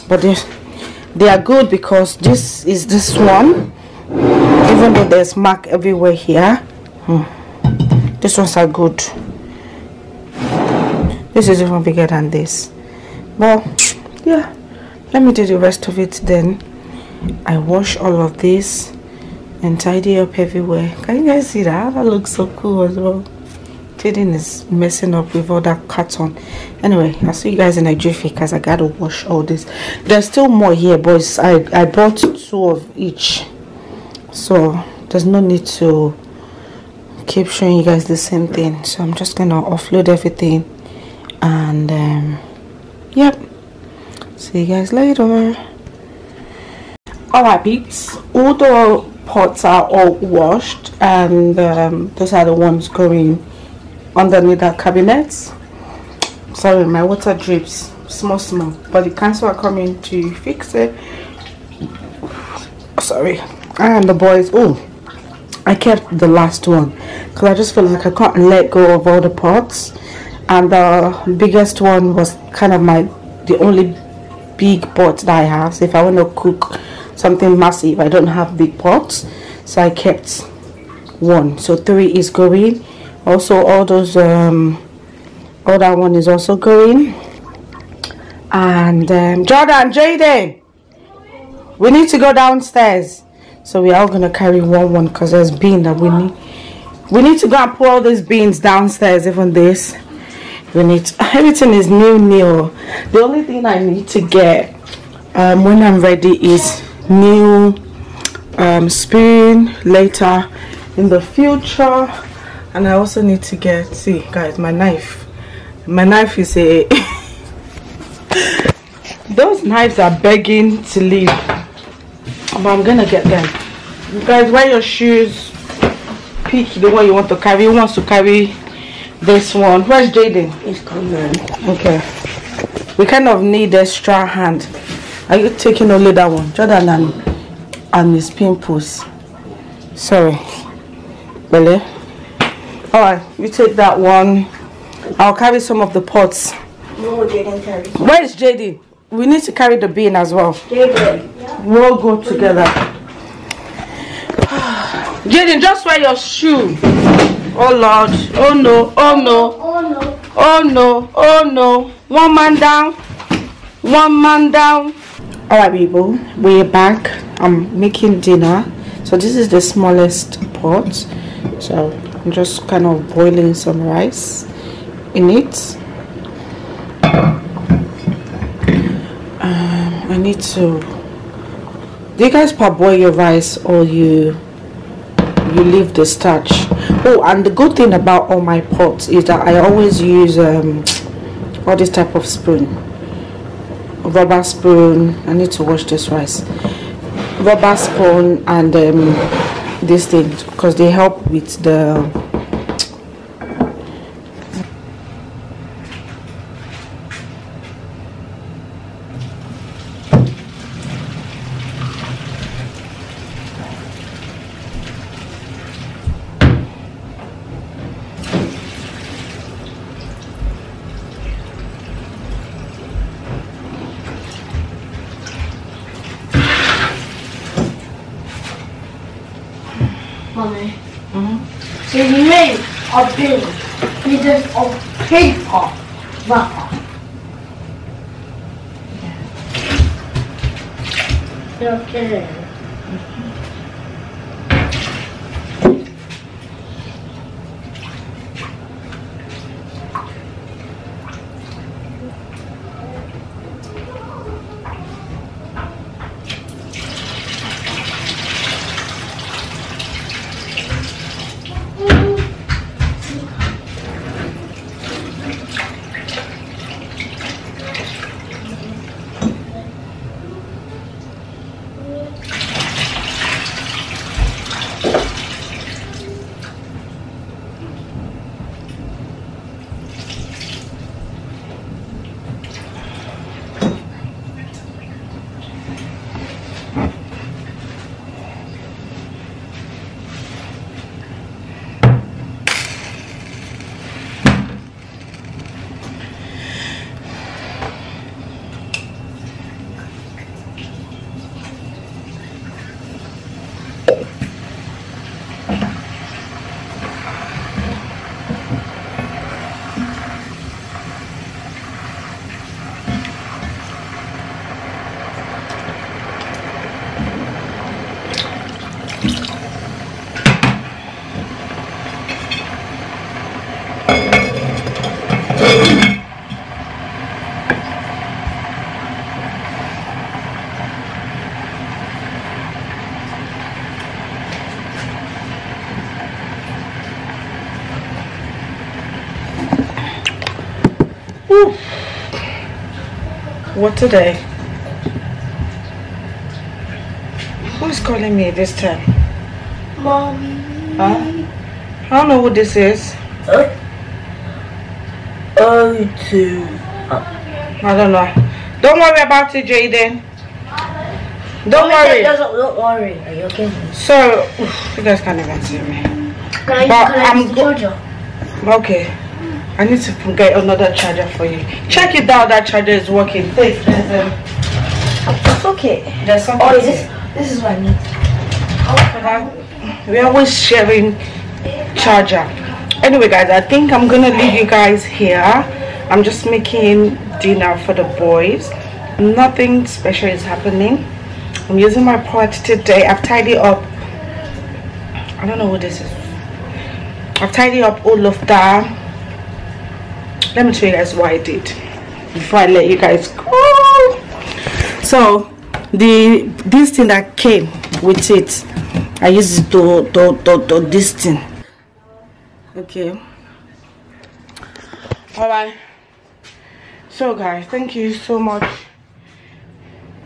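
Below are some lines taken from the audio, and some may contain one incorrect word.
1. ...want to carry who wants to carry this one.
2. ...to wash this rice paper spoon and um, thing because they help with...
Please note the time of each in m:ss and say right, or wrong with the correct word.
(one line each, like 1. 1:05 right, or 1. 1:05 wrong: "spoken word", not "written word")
1. 2:07 right
2. 3:15 wrong: "rubber", not "paper".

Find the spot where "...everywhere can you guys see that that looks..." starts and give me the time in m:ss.
0:20.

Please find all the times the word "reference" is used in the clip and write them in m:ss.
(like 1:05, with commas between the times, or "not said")
not said.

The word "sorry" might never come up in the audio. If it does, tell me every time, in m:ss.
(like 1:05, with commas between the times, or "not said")
0:56, 1:02, 2:19.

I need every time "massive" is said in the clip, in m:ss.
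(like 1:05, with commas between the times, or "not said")
1:17.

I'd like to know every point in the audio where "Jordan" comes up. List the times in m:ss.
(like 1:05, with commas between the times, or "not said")
1:29, 2:16.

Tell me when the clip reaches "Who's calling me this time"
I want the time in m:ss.
5:47.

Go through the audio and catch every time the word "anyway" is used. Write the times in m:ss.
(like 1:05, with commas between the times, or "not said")
0:26, 6:22.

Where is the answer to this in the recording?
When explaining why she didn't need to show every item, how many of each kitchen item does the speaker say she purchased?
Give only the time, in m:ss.
0:32.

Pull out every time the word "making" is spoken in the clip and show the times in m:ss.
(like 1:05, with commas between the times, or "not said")
2:47, 6:26.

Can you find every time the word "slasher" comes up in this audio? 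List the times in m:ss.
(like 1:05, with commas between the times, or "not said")
not said.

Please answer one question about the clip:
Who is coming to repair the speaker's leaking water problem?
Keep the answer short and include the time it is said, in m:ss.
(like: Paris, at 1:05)
The council, at 0:59.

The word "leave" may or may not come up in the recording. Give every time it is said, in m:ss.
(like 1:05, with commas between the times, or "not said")
2:01, 3:05, 6:24.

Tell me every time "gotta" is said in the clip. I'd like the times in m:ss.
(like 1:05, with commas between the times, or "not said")
0:28.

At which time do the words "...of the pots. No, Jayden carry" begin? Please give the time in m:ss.
2:25.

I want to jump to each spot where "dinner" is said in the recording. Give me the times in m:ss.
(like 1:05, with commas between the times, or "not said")
2:48, 6:27.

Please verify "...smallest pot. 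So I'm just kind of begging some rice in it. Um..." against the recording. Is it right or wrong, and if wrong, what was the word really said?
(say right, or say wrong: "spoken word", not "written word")
wrong: "boiling", not "begging".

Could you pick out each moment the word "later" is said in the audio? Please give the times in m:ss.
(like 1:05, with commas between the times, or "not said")
0:44, 1:49.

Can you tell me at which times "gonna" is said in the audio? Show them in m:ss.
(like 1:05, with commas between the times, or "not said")
0:39, 1:34, 2:02, 6:23.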